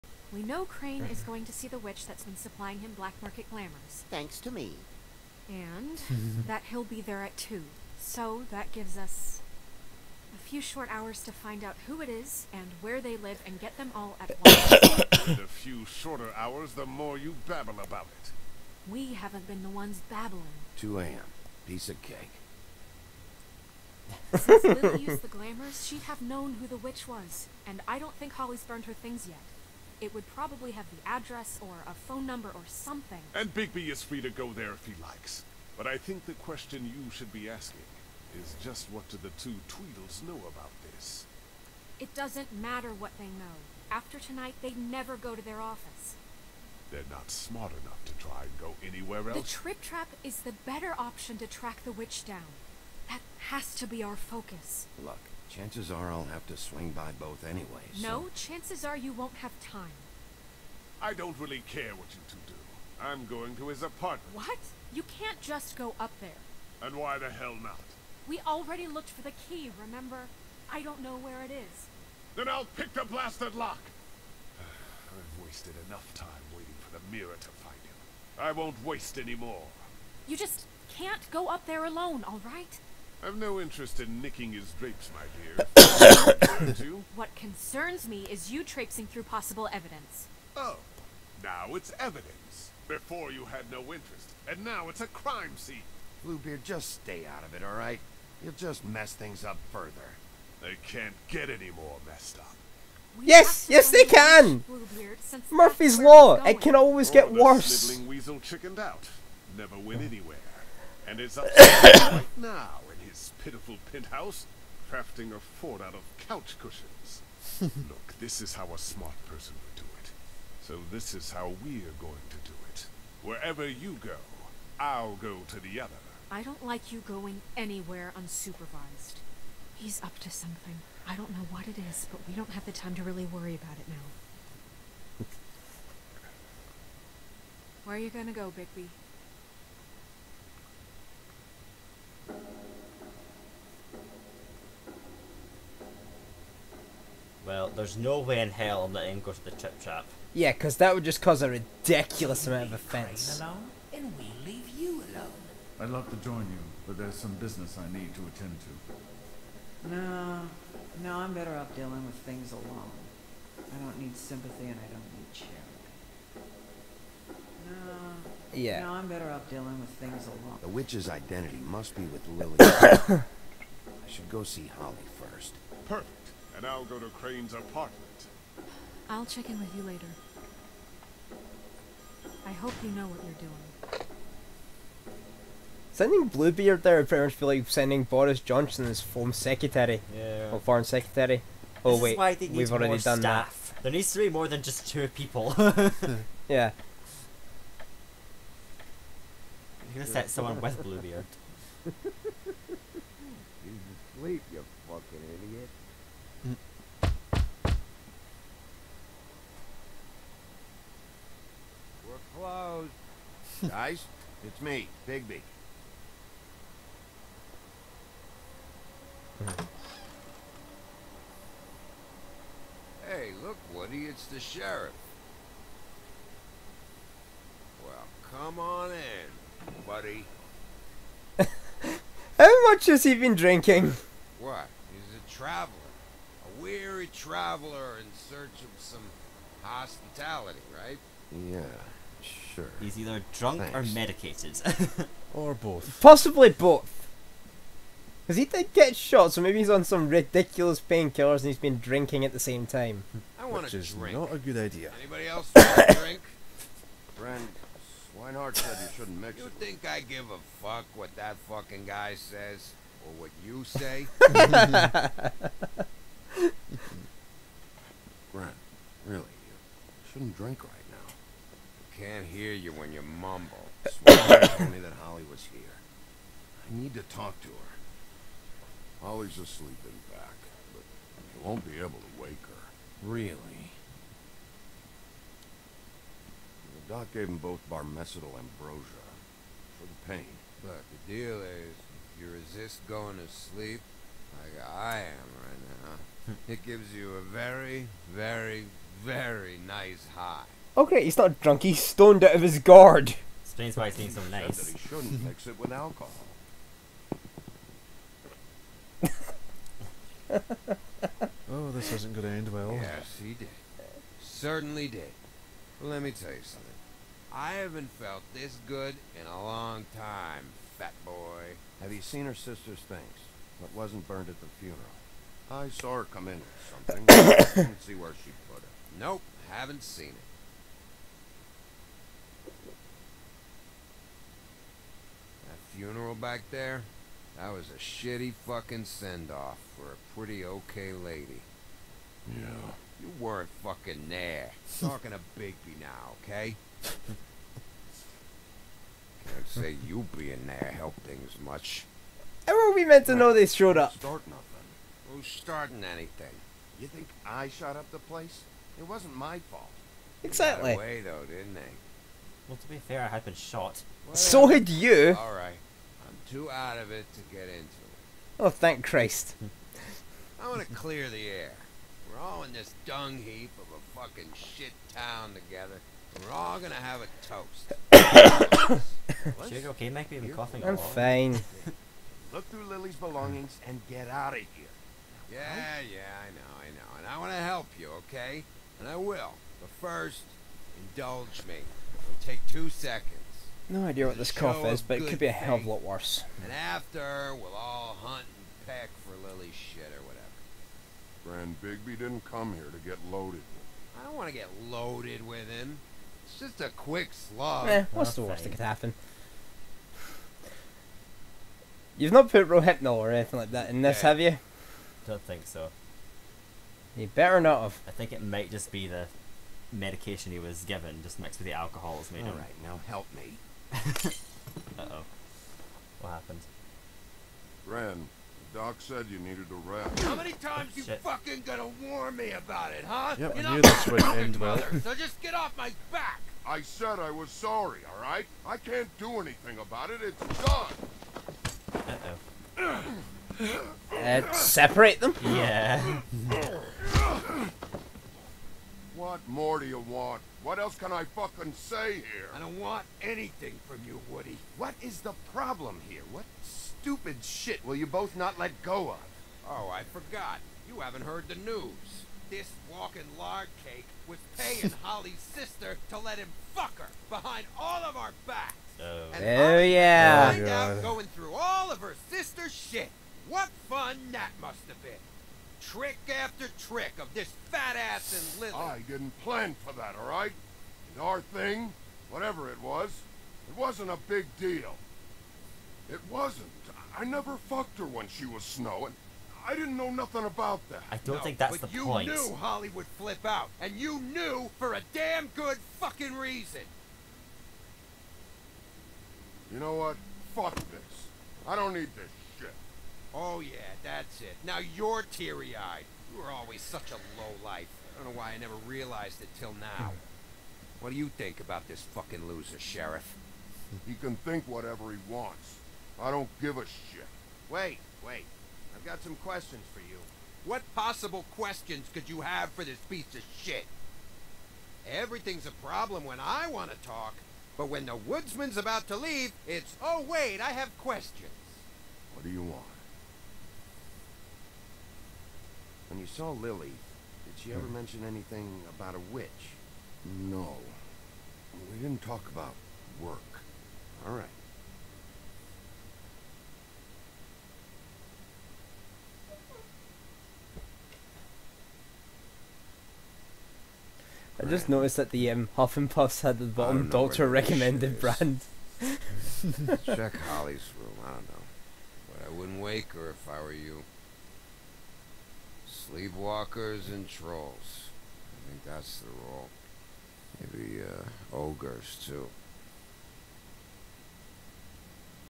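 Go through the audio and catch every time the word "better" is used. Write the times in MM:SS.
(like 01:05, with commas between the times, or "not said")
00:50, 02:41, 02:49, 06:57.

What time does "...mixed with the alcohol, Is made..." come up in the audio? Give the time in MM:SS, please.
07:01.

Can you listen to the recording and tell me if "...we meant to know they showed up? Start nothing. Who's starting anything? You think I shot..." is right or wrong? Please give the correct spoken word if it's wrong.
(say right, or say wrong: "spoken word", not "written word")
right.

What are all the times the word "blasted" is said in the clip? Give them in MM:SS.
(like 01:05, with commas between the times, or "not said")
01:13.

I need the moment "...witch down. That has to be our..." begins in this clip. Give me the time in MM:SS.
00:51.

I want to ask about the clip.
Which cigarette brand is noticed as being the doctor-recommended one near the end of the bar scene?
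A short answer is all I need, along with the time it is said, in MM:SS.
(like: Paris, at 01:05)
Huff and Puffs, at 09:15.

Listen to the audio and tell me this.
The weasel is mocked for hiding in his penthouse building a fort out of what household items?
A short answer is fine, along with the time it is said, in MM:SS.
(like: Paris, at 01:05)
Couch cushions, at 01:56.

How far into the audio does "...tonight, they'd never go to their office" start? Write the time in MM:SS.
00:44.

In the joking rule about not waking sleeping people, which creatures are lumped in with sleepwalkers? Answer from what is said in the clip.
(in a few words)
Trolls.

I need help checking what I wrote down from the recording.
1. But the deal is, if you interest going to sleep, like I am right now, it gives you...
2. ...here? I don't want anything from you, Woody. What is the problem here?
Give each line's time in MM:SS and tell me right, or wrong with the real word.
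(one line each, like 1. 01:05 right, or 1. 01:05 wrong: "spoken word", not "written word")
1. 04:50 wrong: "resist", not "interest"
2. 07:31 right.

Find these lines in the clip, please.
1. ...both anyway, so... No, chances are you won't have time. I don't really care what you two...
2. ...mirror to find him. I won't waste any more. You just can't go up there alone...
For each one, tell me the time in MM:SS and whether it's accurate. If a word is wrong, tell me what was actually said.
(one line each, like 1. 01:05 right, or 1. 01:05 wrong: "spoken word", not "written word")
1. 00:57 right
2. 01:17 right.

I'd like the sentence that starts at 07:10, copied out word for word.
How many times oh, you fucking gonna warn me about it, huh?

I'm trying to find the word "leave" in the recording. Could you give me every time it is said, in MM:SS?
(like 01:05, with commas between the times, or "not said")
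02:34, 08:48.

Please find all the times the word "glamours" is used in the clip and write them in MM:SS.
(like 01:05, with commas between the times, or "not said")
00:03, 00:25.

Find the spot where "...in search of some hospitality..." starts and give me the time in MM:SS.
03:57.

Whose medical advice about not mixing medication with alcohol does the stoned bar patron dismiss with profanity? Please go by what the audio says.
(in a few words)
Swineheart.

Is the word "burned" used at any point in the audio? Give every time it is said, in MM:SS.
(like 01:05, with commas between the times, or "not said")
00:28, 05:24.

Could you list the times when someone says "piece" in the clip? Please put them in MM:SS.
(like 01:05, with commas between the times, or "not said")
00:21, 08:42.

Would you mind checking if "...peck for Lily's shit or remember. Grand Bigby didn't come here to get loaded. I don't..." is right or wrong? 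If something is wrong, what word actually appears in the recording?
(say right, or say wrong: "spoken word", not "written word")
wrong: "whatever", not "remember".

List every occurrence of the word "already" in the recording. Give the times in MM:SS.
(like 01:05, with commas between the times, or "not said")
01:08, 03:12.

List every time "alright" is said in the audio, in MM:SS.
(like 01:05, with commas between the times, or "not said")
07:17.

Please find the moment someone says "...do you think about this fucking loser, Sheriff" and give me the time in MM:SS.
08:30.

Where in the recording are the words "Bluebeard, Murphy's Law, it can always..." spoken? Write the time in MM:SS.
01:44.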